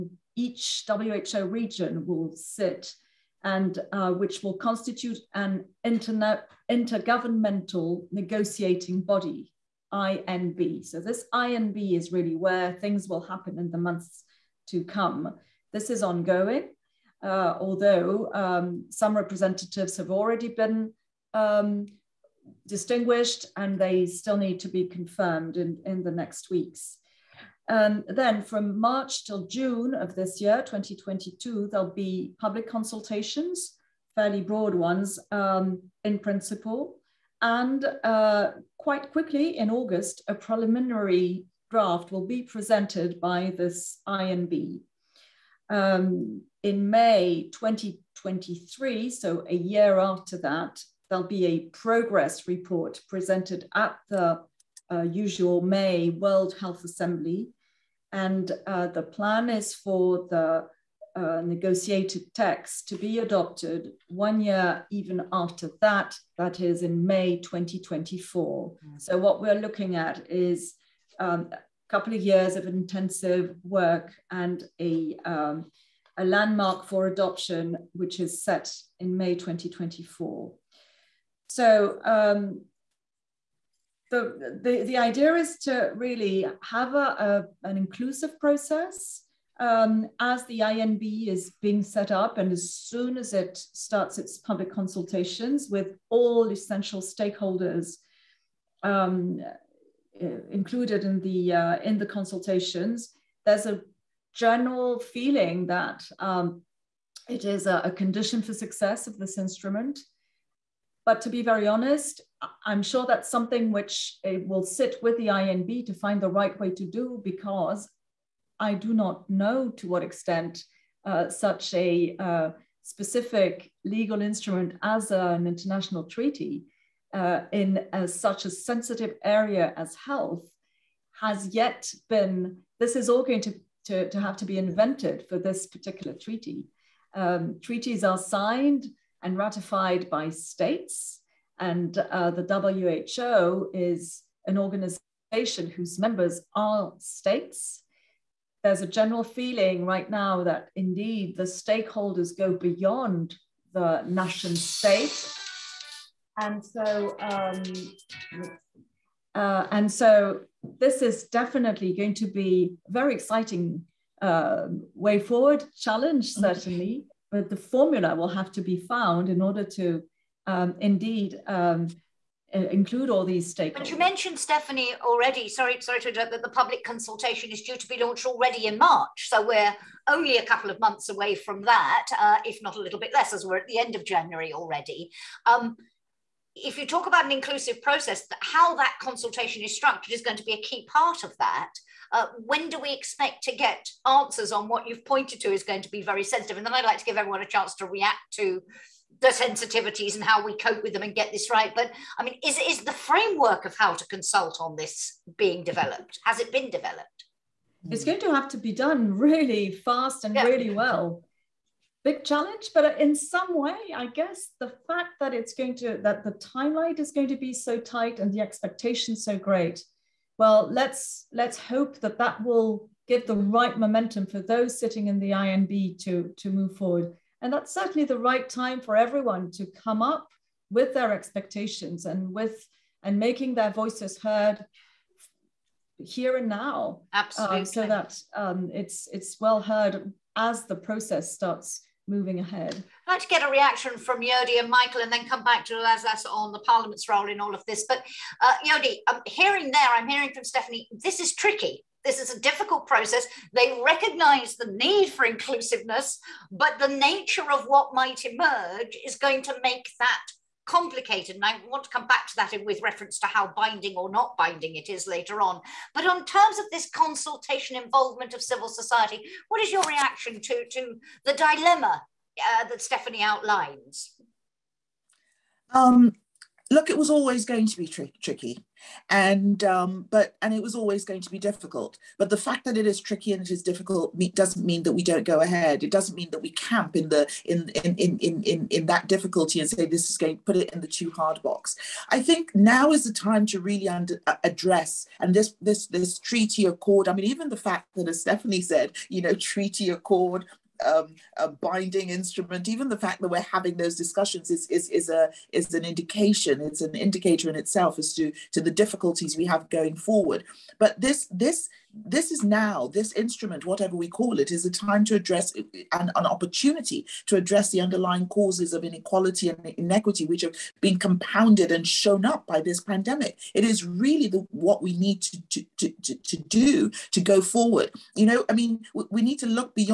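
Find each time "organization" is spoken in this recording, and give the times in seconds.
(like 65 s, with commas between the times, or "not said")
144 s.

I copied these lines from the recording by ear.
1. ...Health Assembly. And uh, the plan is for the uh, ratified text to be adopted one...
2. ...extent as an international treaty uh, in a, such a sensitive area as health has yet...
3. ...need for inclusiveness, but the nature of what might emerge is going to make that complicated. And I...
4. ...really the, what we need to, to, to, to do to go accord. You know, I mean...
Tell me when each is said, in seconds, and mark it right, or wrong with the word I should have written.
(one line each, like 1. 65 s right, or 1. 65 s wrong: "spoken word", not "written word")
1. 56 s wrong: "negotiated", not "ratified"
2. 124 s wrong: "instrument", not "extent"
3. 254 s right
4. 323 s wrong: "forward", not "accord".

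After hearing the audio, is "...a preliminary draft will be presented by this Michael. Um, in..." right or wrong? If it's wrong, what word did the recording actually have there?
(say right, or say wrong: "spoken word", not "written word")
wrong: "INB", not "Michael".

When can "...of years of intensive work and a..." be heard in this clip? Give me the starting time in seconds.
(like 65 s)
72 s.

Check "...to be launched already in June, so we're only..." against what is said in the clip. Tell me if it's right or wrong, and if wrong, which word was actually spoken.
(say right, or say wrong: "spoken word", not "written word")
wrong: "March", not "June".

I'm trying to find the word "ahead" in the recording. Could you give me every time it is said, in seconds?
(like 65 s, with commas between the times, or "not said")
242 s, 285 s.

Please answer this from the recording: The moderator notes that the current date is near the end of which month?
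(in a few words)
January.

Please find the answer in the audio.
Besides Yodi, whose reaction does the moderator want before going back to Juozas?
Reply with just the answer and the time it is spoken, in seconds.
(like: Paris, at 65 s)
Michael, at 244 s.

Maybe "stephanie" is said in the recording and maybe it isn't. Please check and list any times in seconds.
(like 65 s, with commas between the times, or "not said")
174 s, 250 s, 272 s, 298 s.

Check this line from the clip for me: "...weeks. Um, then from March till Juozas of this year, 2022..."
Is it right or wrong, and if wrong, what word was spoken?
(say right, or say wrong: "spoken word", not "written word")
wrong: "June", not "Juozas".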